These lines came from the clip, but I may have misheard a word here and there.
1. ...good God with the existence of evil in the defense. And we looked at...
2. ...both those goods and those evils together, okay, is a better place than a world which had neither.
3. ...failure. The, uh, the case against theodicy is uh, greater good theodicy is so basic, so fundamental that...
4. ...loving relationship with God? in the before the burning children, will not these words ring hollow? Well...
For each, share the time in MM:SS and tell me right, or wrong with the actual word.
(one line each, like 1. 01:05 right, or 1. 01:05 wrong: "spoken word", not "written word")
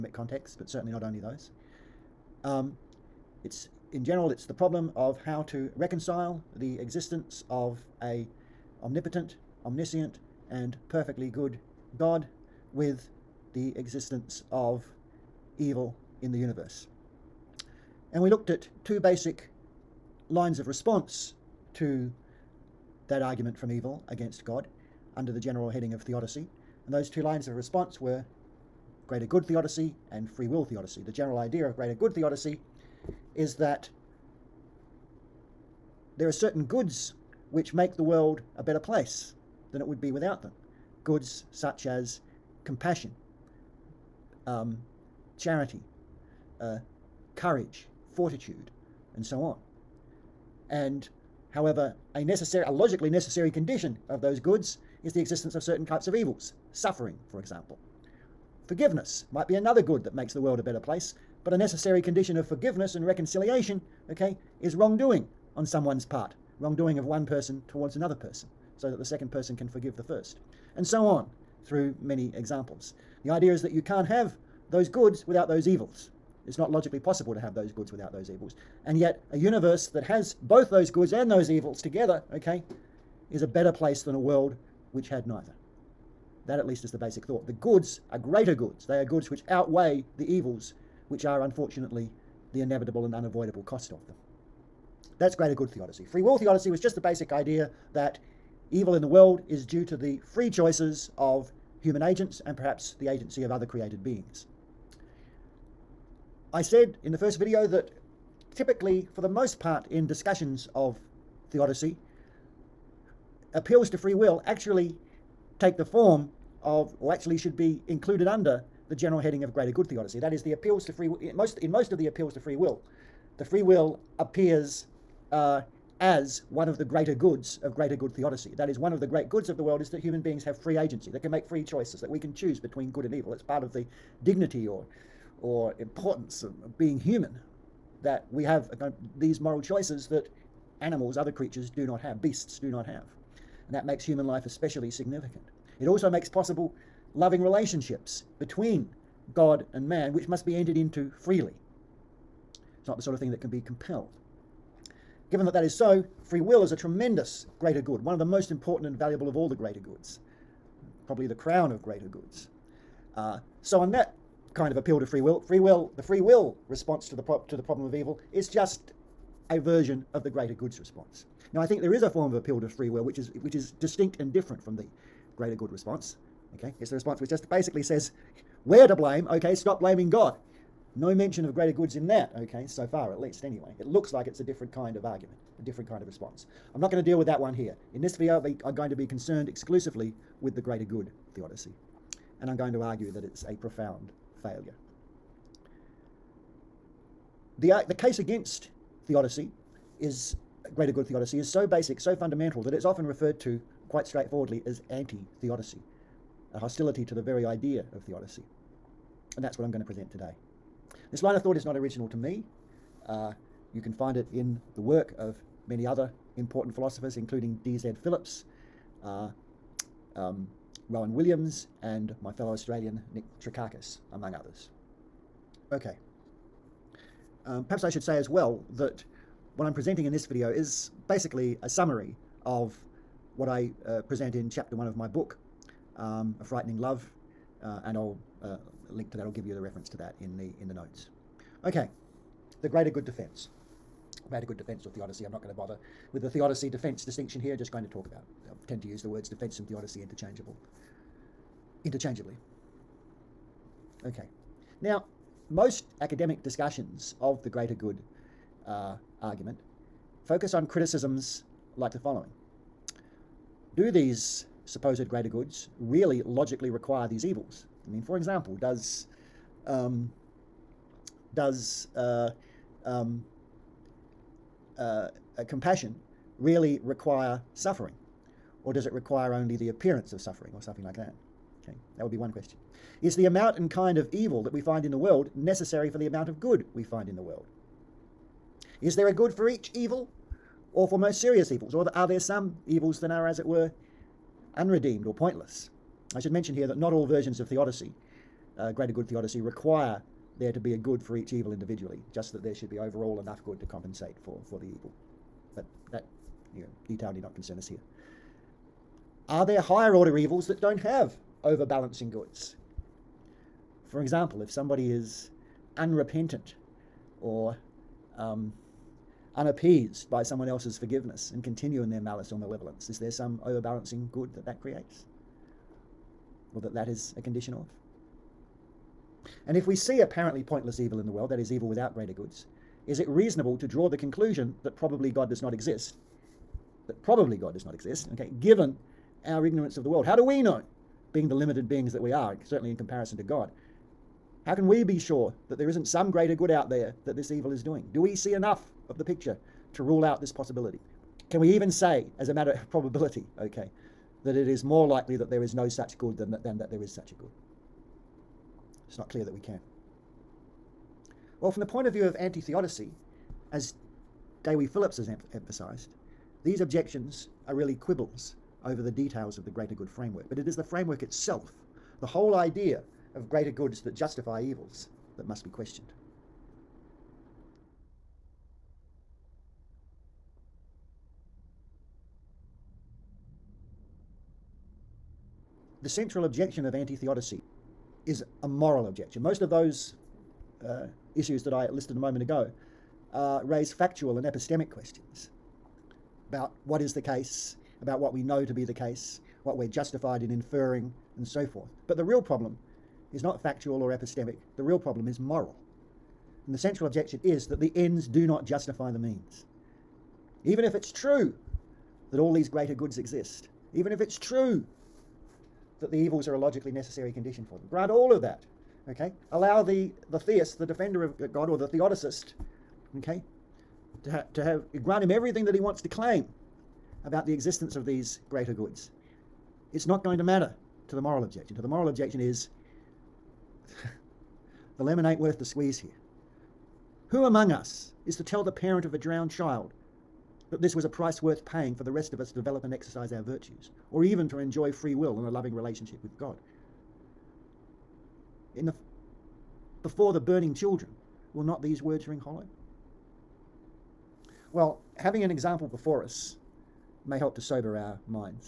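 1. 00:11 wrong: "universe", not "defense"
2. 01:20 right
3. 03:14 right
4. 07:25 right.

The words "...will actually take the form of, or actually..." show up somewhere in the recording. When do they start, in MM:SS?
01:54.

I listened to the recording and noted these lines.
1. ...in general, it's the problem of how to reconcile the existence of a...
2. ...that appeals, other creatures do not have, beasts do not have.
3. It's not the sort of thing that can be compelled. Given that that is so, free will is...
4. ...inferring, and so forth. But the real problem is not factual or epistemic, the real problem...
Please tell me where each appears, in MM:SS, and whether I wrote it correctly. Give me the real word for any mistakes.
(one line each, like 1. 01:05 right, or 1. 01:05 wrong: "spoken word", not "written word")
1. 00:03 right
2. 02:20 wrong: "animals", not "appeals"
3. 02:32 right
4. 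06:40 right.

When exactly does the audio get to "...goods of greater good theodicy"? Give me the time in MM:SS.
02:07.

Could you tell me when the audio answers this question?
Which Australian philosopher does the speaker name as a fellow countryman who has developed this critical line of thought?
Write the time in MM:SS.
03:43.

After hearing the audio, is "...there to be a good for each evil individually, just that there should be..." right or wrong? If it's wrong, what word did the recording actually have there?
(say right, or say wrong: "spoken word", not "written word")
right.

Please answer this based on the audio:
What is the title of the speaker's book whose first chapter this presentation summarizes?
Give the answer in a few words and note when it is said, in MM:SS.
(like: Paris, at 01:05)
A Frightening Love, at 03:56.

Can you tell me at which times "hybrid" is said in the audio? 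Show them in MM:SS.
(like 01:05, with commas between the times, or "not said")
not said.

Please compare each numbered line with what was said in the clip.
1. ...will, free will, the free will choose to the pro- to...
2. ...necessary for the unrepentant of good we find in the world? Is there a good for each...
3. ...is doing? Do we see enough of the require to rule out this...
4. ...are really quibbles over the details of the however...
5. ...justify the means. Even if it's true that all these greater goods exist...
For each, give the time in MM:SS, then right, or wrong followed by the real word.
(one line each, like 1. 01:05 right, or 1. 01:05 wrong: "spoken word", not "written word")
1. 02:45 wrong: "response", not "choose"
2. 04:45 wrong: "amount", not "unrepentant"
3. 05:47 wrong: "picture", not "require"
4. 06:07 wrong: "greater", not "however"
5. 06:48 right.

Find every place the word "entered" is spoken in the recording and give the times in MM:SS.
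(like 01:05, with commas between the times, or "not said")
02:30.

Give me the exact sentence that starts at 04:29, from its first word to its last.
Um, does uh, um, uh, uh compassion really require suffering?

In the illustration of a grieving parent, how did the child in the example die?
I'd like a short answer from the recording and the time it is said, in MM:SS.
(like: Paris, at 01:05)
Drowned, at 07:18.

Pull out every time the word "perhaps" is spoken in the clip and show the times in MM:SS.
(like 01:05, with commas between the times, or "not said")
01:42, 03:47.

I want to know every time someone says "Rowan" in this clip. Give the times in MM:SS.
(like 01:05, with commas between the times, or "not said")
03:40.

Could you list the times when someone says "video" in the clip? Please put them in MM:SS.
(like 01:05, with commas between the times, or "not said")
01:47, 03:08, 03:50.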